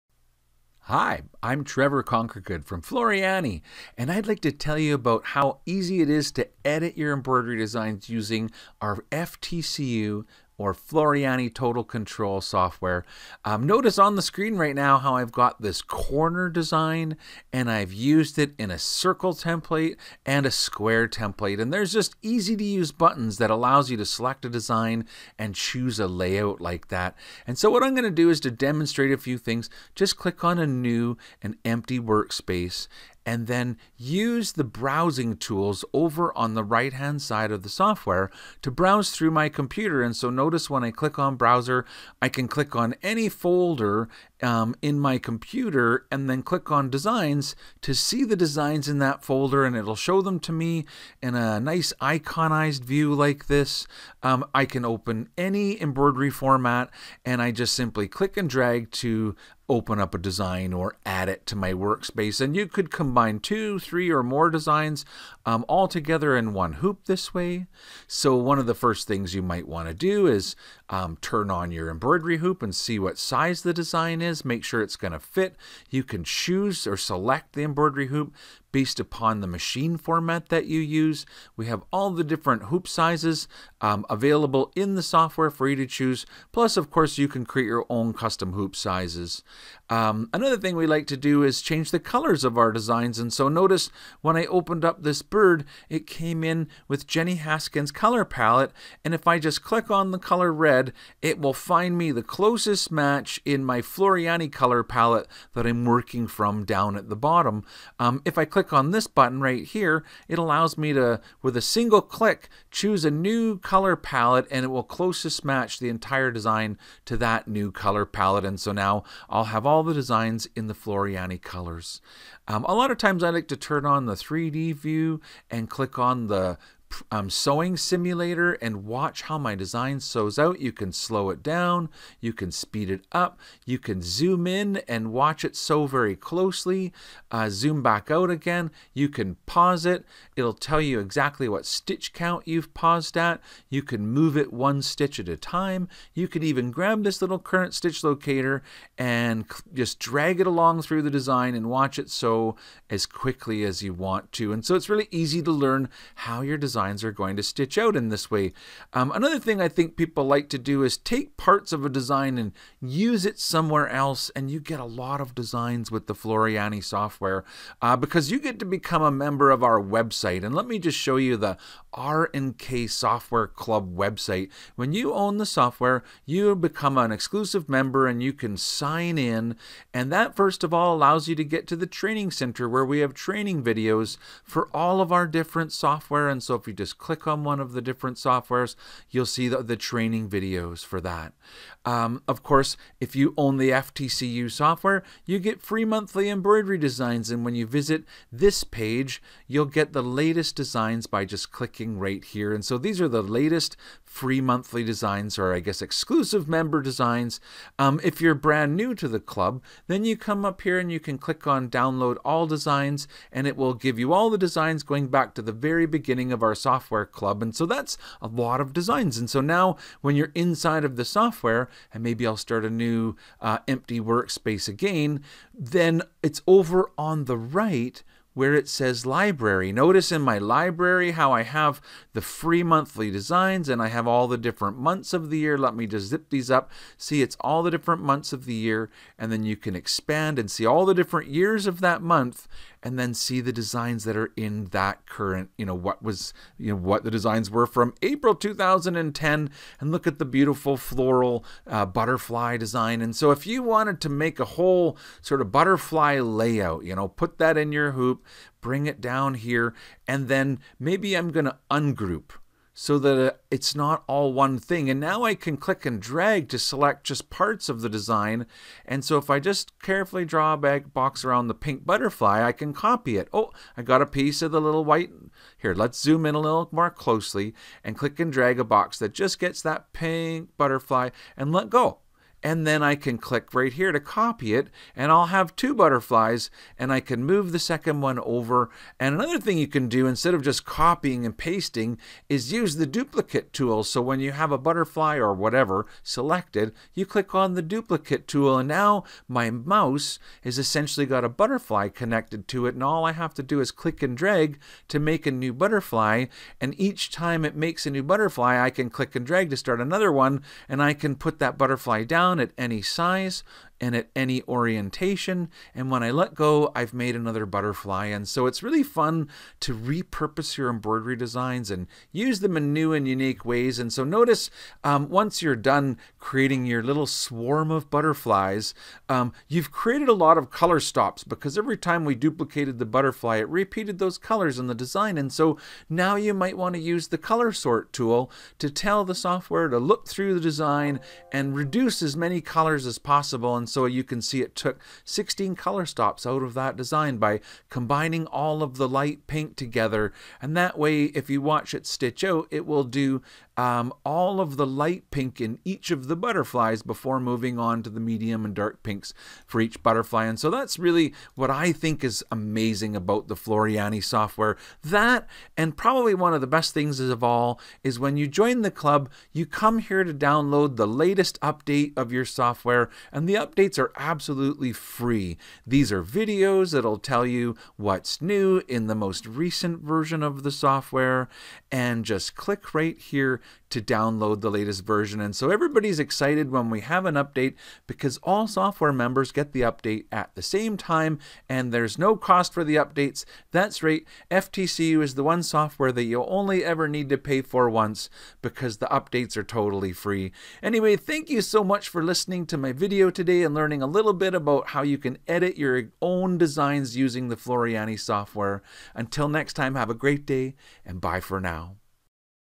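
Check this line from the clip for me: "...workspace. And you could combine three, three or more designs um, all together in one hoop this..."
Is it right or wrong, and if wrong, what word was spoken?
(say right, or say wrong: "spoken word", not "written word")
wrong: "two", not "three".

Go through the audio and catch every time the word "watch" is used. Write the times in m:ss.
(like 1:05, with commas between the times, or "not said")
2:08, 2:15, 2:31, 5:51.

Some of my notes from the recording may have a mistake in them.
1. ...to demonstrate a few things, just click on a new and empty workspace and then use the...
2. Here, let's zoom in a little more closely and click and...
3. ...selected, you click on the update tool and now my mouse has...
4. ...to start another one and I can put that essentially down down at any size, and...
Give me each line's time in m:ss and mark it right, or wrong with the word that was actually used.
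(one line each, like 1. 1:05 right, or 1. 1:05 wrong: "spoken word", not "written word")
1. 0:28 right
2. 4:35 right
3. 4:56 wrong: "duplicate", not "update"
4. 5:09 wrong: "butterfly", not "essentially".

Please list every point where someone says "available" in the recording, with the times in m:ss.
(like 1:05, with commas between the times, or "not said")
1:24.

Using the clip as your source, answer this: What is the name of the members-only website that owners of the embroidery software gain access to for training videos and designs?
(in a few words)
RNK Software Club.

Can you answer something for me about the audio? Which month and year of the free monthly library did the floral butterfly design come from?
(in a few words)
April 2010.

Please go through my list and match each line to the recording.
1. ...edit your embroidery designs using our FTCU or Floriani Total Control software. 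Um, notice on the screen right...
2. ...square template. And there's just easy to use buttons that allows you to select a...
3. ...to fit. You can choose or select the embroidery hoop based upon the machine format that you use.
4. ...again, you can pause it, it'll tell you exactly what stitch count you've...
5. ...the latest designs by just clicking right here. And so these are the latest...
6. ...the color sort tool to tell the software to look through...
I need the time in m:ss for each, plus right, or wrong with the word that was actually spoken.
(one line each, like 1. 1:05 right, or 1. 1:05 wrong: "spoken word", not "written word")
1. 0:06 right
2. 0:20 right
3. 1:15 right
4. 2:18 right
5. 3:19 right
6. 5:37 right.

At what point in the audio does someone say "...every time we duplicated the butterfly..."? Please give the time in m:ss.
5:31.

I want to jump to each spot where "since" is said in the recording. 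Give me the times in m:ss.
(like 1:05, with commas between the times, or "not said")
not said.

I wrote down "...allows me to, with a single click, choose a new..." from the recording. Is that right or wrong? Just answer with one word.
right.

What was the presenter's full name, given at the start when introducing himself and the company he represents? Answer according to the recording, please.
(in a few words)
Trevor Conquergood.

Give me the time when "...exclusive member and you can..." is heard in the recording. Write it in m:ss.
2:57.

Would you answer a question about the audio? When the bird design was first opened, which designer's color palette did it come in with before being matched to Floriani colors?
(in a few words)
Jenny Haskins.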